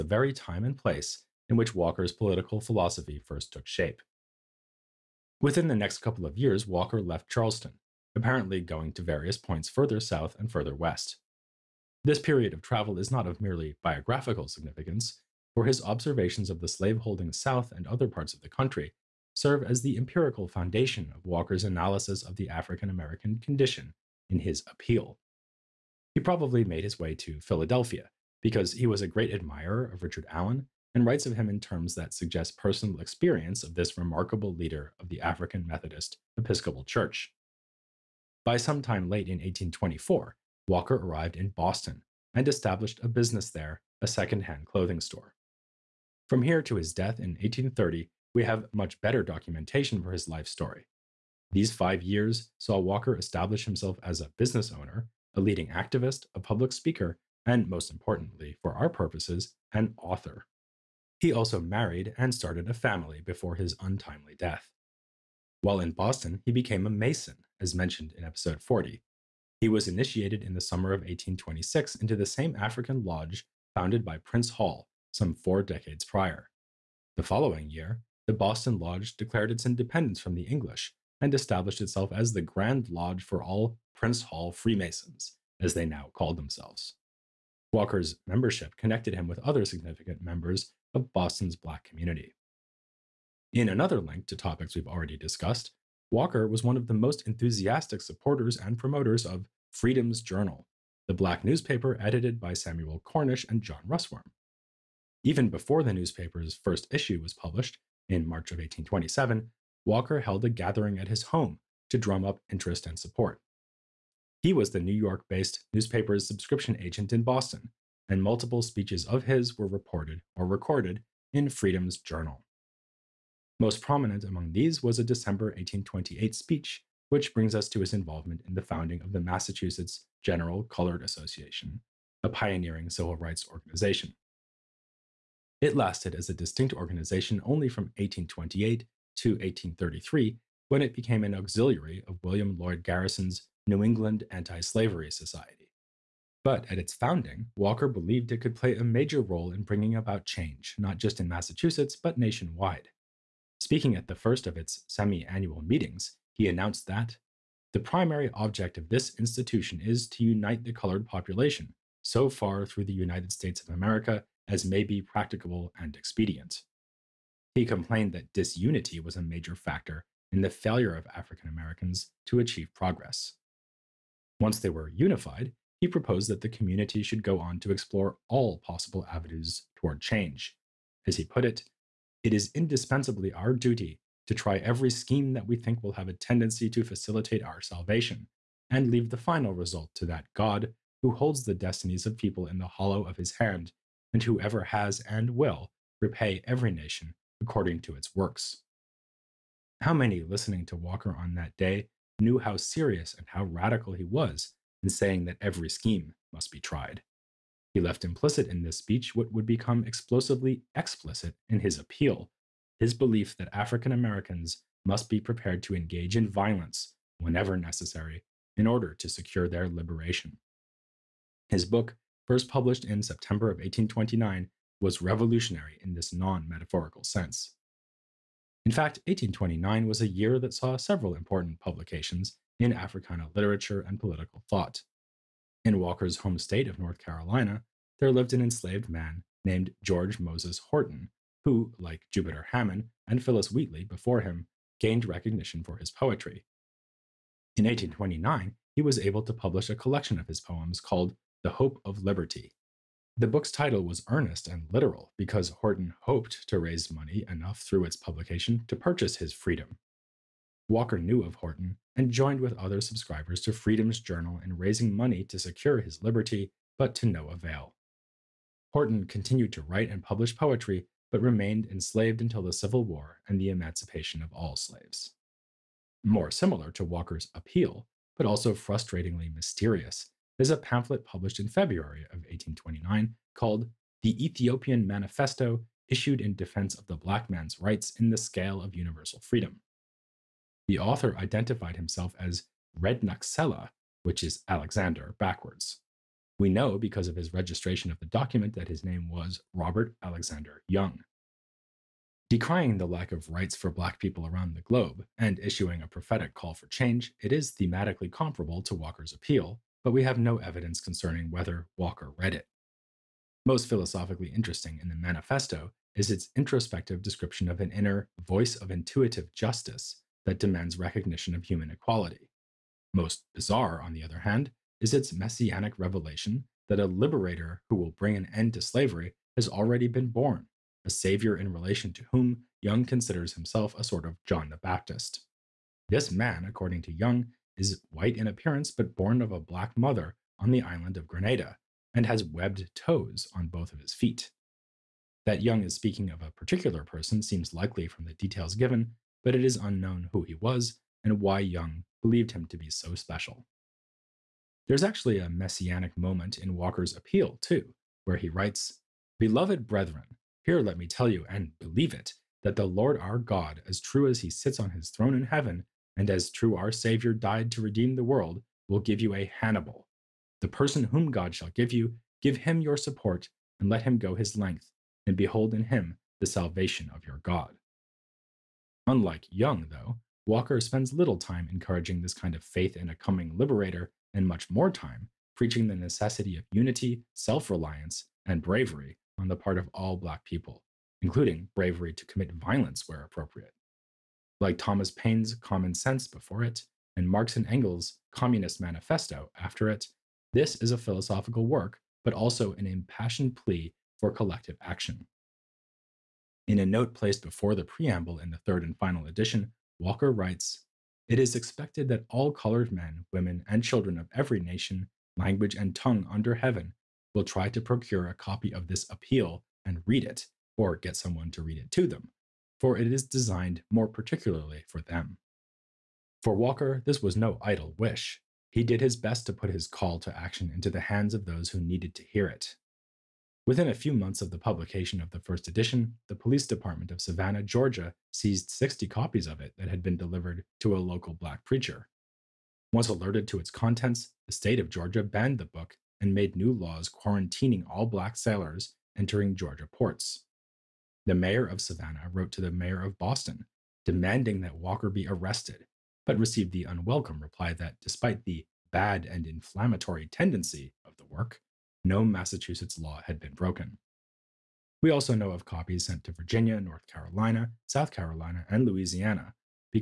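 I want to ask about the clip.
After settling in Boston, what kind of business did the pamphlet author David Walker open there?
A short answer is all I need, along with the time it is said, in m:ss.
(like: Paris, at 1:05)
Second-hand clothing store, at 0:44.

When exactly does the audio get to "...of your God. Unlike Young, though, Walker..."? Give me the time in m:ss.
6:16.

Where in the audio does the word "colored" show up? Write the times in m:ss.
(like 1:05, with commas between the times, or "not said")
2:10, 2:40, 6:52.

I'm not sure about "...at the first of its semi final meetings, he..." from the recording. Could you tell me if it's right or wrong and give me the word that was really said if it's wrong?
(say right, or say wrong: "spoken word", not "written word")
wrong: "annual", not "final".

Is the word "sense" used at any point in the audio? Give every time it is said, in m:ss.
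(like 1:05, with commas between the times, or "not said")
3:47, 6:35.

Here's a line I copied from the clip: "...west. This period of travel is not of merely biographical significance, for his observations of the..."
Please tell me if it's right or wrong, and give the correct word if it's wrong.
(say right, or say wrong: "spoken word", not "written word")
right.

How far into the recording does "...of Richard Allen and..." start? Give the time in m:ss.
0:29.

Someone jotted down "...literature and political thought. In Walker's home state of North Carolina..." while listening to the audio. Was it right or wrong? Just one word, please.
right.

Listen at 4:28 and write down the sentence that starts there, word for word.
Horton continued to write and publish poetry, but remained enslaved until the Civil War and the emancipation of all slaves.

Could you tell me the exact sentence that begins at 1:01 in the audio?
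He also married and started a family before his untimely death.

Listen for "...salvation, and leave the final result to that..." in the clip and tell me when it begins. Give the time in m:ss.
3:07.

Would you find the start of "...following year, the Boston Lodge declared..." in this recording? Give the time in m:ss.
1:17.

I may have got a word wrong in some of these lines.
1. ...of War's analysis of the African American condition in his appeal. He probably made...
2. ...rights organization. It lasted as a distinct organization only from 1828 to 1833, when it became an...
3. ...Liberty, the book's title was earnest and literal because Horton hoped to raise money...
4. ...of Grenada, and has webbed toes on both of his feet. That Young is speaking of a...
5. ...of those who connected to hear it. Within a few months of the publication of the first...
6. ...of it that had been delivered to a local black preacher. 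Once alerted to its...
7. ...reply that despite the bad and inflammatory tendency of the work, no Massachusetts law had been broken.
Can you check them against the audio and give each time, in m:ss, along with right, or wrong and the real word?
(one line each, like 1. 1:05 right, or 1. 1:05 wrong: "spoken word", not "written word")
1. 0:21 wrong: "Walker", not "War"
2. 2:13 right
3. 4:12 right
4. 5:40 right
5. 7:11 wrong: "needed", not "connected"
6. 7:19 right
7. 7:37 right.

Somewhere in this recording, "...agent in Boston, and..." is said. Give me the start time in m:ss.
1:56.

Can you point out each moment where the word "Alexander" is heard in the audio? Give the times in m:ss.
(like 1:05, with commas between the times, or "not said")
4:54, 5:00.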